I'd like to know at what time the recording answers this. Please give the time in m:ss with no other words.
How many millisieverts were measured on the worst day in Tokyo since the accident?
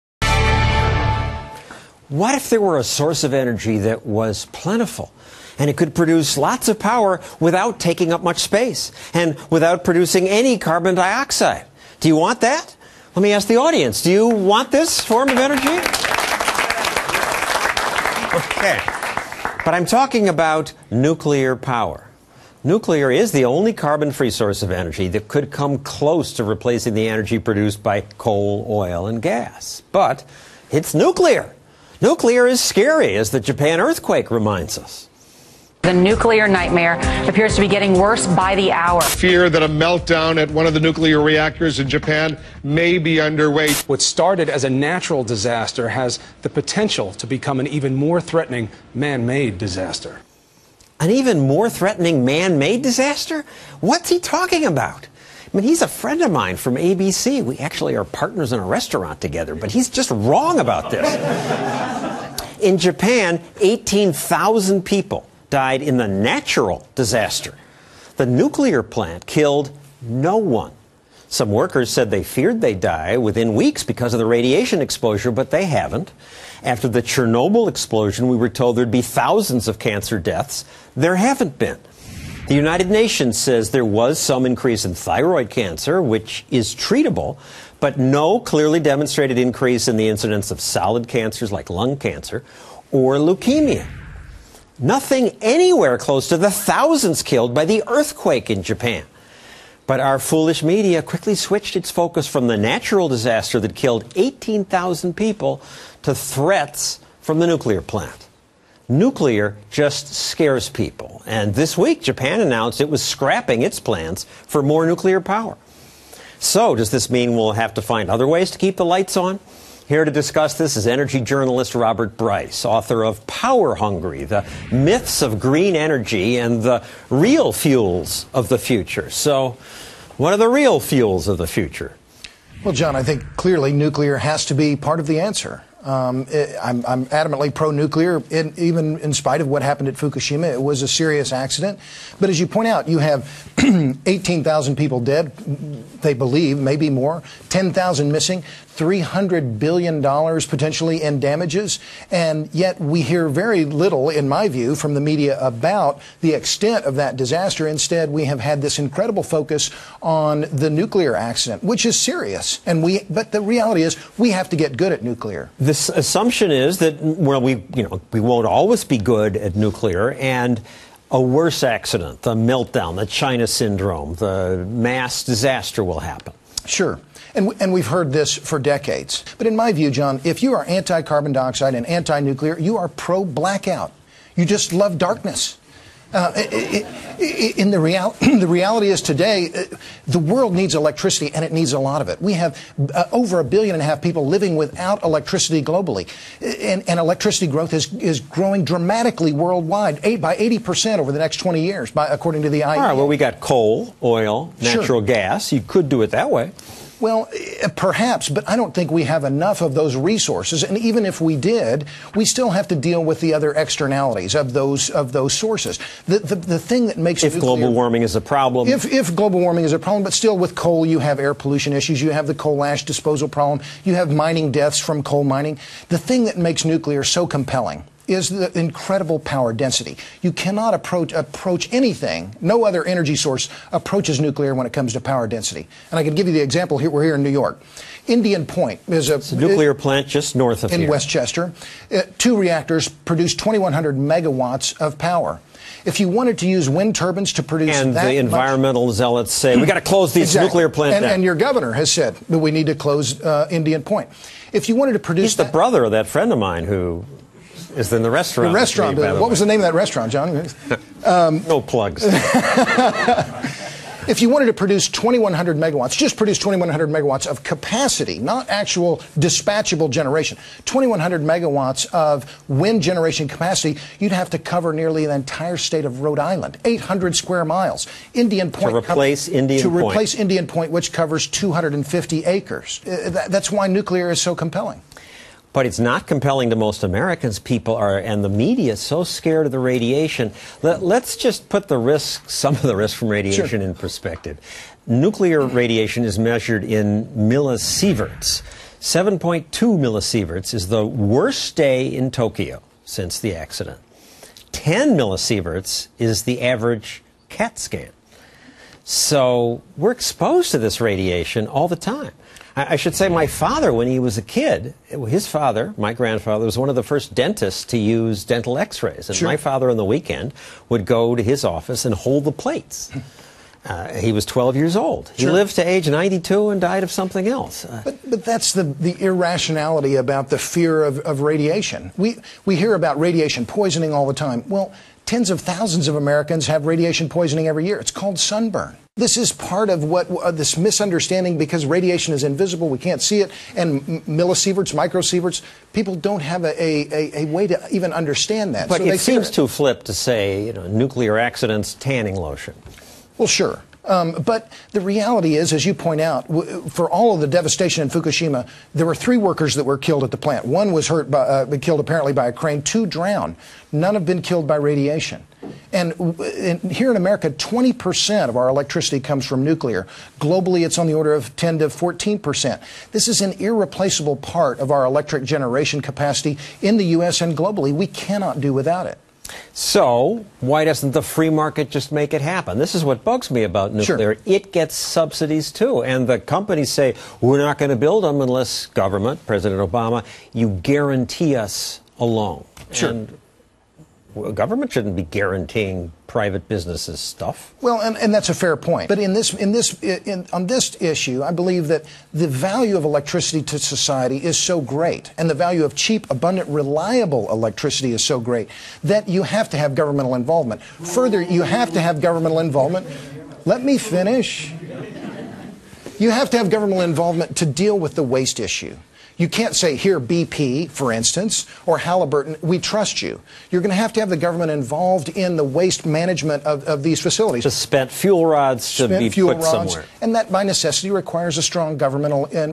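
4:58.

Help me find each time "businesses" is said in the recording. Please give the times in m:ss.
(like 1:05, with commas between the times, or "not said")
6:36.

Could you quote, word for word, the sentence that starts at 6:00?
One was hurt, by, uh, killed apparently by a crane.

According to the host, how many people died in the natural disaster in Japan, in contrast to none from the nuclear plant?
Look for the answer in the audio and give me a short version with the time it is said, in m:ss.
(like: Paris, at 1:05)
18,000, at 1:03.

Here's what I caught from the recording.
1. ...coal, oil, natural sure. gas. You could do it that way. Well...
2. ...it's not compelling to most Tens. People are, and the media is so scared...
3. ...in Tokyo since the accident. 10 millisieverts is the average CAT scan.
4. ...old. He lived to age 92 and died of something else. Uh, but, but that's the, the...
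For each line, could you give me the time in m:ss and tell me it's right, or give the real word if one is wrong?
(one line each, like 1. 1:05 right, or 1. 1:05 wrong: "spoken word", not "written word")
1. 3:23 right
2. 4:45 wrong: "Americans", not "Tens"
3. 5:01 right
4. 5:24 right.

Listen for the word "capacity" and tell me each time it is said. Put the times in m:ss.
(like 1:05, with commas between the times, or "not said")
4:27, 4:33, 6:15.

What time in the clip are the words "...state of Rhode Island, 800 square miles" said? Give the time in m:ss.
4:35.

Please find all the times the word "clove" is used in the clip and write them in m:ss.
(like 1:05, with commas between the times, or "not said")
not said.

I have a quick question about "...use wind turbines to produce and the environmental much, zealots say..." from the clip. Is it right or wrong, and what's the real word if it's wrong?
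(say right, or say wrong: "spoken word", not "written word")
right.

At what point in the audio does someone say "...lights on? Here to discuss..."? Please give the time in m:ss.
1:58.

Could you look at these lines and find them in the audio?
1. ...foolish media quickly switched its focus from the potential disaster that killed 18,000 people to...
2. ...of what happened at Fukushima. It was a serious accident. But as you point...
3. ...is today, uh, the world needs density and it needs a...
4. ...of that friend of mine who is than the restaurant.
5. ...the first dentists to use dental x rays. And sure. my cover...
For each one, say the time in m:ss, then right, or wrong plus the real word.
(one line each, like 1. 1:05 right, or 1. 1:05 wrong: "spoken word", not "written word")
1. 1:40 wrong: "natural", not "potential"
2. 2:19 right
3. 3:08 wrong: "electricity", not "density"
4. 4:15 right
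5. 5:16 wrong: "father", not "cover".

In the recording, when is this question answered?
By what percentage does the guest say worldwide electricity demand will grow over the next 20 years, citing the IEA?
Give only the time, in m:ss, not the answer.
3:20.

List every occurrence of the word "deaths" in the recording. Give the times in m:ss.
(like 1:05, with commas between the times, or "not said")
1:20, 3:44.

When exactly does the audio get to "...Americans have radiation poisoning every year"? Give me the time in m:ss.
5:35.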